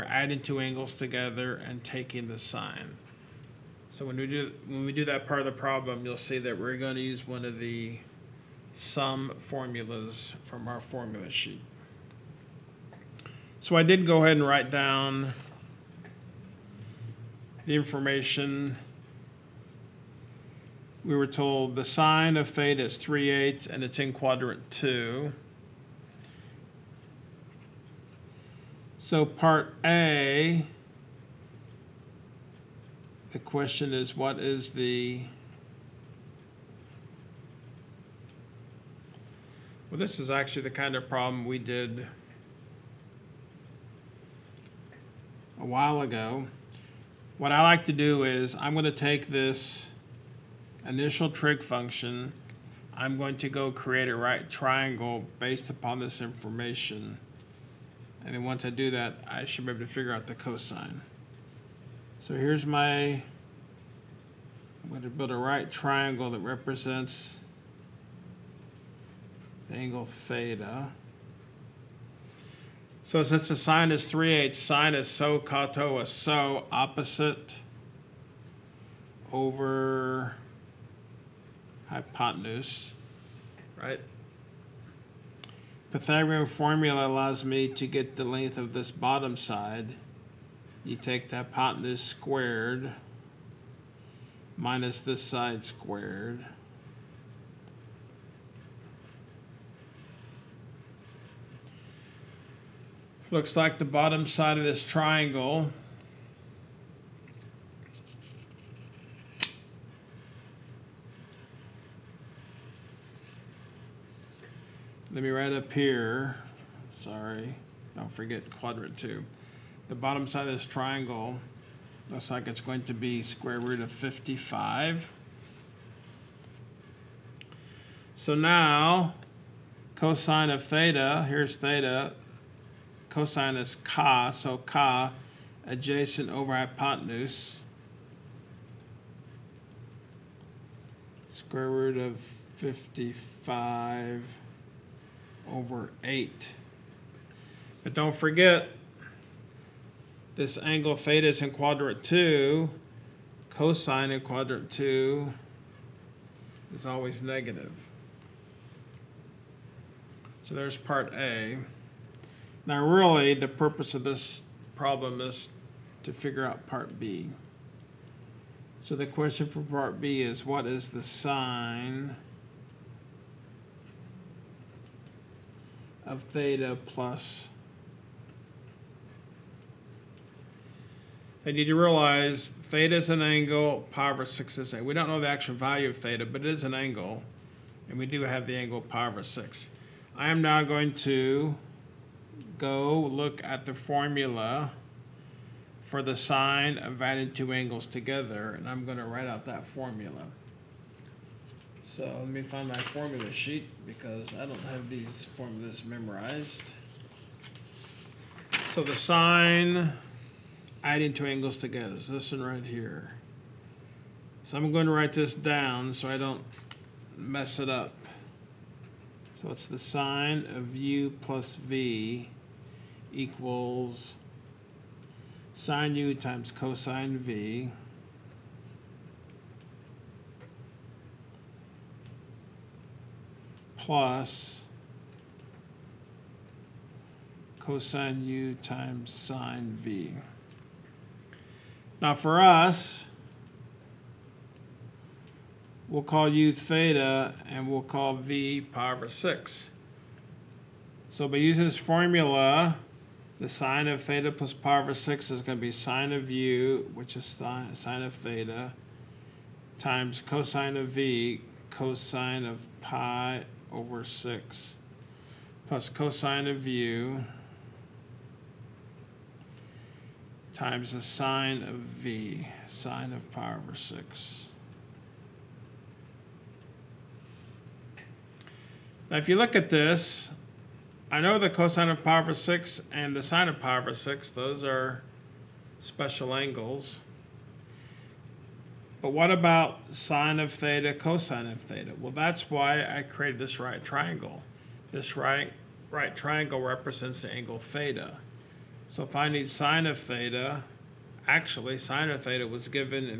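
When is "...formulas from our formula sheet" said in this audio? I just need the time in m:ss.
0:09.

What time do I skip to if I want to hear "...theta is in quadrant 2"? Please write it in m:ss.
2:30.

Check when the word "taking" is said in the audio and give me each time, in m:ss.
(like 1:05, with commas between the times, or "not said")
0:01.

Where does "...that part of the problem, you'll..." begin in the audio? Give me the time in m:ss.
0:05.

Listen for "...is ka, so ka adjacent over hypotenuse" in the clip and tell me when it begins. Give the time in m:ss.
2:13.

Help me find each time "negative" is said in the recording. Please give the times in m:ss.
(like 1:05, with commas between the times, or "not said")
2:37.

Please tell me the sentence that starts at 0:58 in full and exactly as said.
And then once I do that, I should be able to figure out the cosine.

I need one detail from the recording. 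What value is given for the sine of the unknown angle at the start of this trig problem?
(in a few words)
3/8.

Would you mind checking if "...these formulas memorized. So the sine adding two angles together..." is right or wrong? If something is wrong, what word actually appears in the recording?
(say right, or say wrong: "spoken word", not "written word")
right.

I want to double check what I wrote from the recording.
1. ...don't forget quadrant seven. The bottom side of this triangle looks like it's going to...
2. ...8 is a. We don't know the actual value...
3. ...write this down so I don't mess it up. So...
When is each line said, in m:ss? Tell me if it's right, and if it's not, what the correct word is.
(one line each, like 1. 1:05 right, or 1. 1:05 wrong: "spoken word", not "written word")
1. 1:57 wrong: "two", not "seven"
2. 3:04 wrong: "6", not "8"
3. 3:34 right.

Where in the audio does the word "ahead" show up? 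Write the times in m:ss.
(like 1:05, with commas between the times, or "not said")
0:14.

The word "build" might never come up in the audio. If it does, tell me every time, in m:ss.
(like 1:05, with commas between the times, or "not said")
1:05.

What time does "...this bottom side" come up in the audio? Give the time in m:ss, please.
1:28.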